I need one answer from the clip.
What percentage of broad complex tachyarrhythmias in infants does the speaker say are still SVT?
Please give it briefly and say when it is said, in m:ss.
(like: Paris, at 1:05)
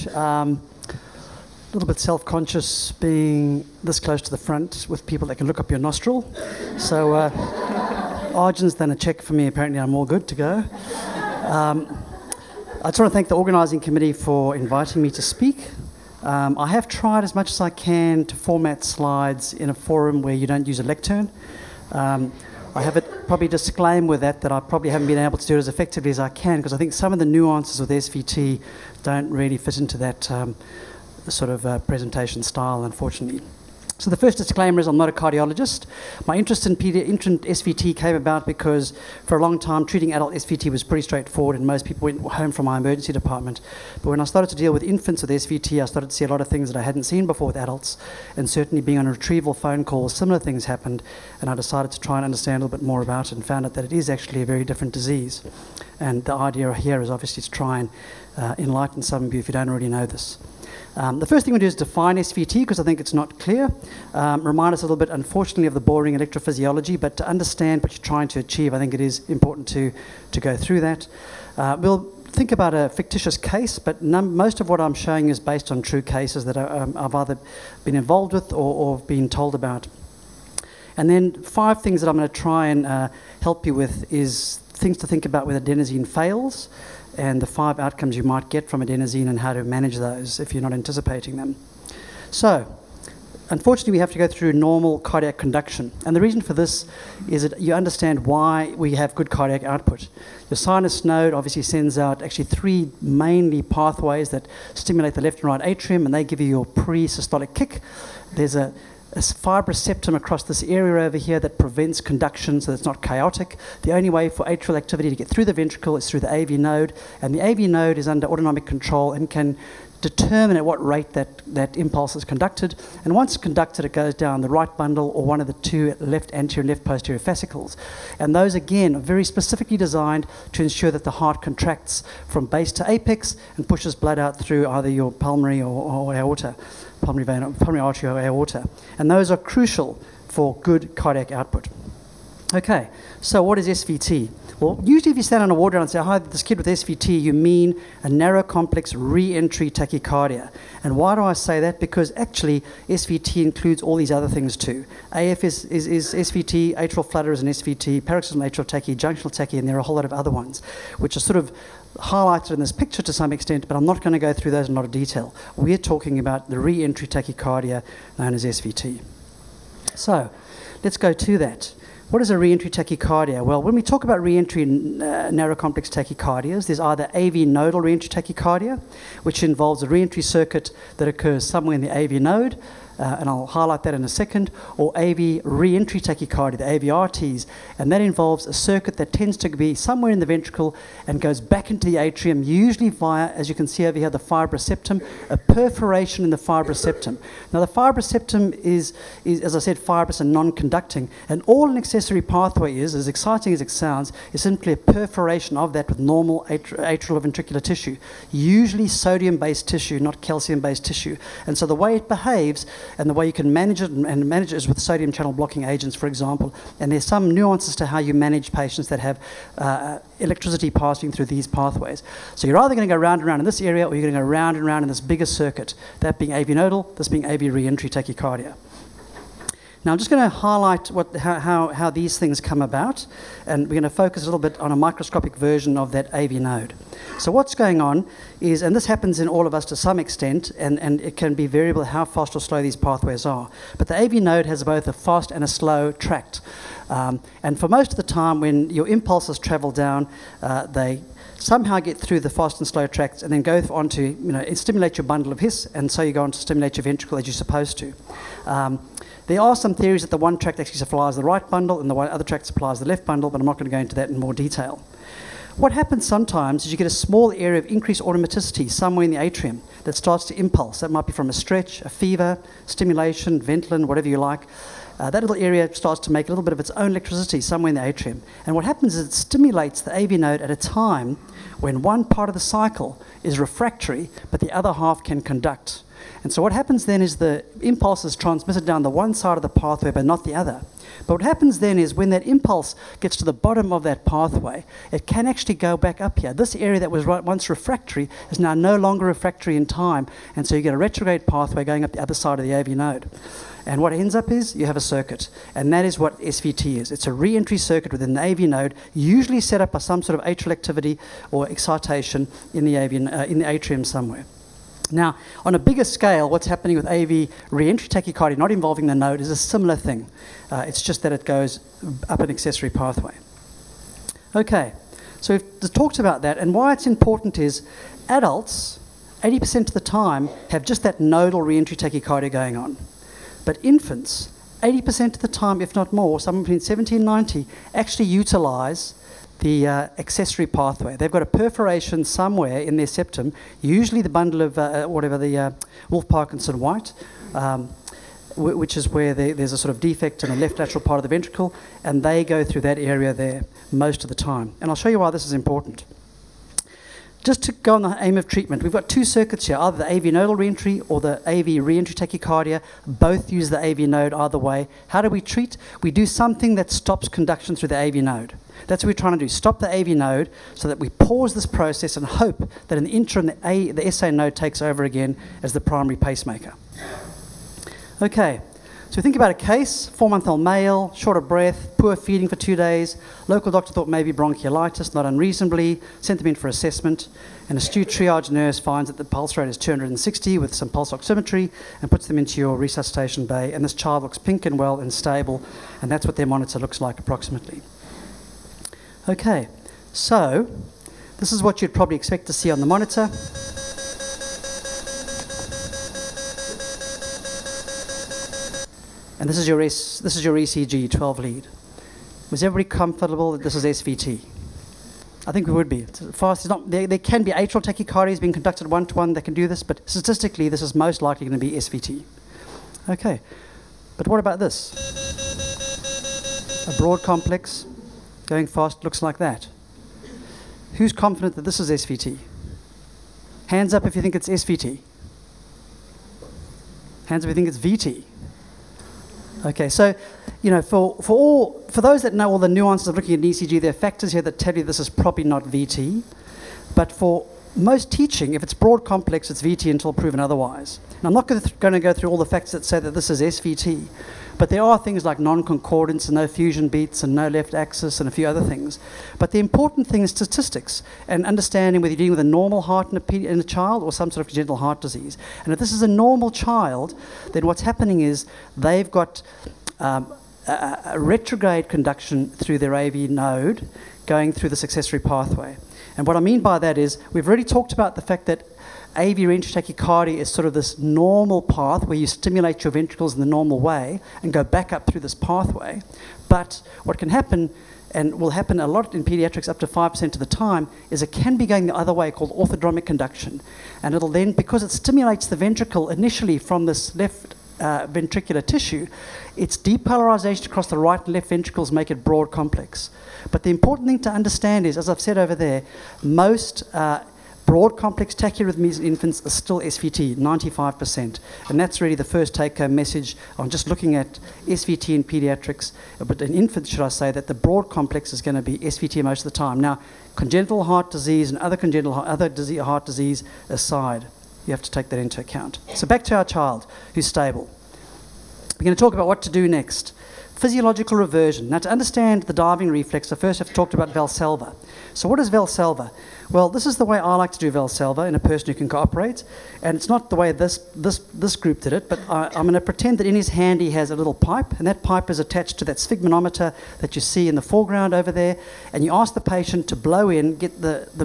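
95%, at 8:30.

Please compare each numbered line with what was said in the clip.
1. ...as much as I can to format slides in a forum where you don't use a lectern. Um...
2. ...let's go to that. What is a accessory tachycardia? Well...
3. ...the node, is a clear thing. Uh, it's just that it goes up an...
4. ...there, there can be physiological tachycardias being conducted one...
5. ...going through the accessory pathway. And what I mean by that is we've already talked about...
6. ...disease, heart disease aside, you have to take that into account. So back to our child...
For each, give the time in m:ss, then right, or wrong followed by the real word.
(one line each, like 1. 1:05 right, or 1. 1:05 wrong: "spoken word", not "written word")
1. 0:17 right
2. 2:50 wrong: "reentry", not "accessory"
3. 5:18 wrong: "similar", not "clear"
4. 6:56 wrong: "atrial", not "physiological"
5. 7:54 right
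6. 8:42 right.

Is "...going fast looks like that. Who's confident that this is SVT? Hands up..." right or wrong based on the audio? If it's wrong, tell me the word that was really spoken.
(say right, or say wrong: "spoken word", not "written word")
right.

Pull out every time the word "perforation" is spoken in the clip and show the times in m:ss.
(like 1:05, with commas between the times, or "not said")
3:15, 3:24, 5:41.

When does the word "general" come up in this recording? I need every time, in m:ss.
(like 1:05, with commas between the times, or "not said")
not said.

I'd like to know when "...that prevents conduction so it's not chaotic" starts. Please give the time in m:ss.
1:51.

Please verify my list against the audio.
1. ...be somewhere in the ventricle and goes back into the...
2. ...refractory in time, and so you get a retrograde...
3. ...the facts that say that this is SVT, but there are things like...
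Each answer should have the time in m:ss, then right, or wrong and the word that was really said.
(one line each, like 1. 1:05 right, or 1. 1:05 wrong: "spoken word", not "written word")
1. 3:09 right
2. 4:59 right
3. 7:32 right.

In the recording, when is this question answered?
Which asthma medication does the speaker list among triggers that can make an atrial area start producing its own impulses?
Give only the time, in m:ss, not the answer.
4:33.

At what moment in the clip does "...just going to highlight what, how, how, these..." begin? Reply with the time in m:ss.
3:49.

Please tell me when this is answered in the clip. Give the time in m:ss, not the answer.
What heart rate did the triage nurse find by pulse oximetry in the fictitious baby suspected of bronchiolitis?
6:29.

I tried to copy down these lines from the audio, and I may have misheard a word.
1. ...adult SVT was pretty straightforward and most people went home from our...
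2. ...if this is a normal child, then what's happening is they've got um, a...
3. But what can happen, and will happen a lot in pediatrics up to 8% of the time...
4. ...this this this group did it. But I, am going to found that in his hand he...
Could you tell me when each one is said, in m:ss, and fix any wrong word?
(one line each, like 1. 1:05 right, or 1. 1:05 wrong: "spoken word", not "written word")
1. 0:40 right
2. 7:45 right
3. 8:06 wrong: "5", not "8"
4. 9:00 wrong: "pretend", not "found".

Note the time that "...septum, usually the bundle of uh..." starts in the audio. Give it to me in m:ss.
5:42.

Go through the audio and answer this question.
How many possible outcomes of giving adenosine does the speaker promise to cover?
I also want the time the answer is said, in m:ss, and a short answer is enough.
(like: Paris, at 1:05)
5, at 1:27.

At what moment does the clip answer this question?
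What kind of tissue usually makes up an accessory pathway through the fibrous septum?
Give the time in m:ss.
3:28.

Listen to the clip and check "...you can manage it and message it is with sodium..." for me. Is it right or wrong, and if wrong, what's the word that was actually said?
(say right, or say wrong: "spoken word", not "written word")
wrong: "manage", not "message".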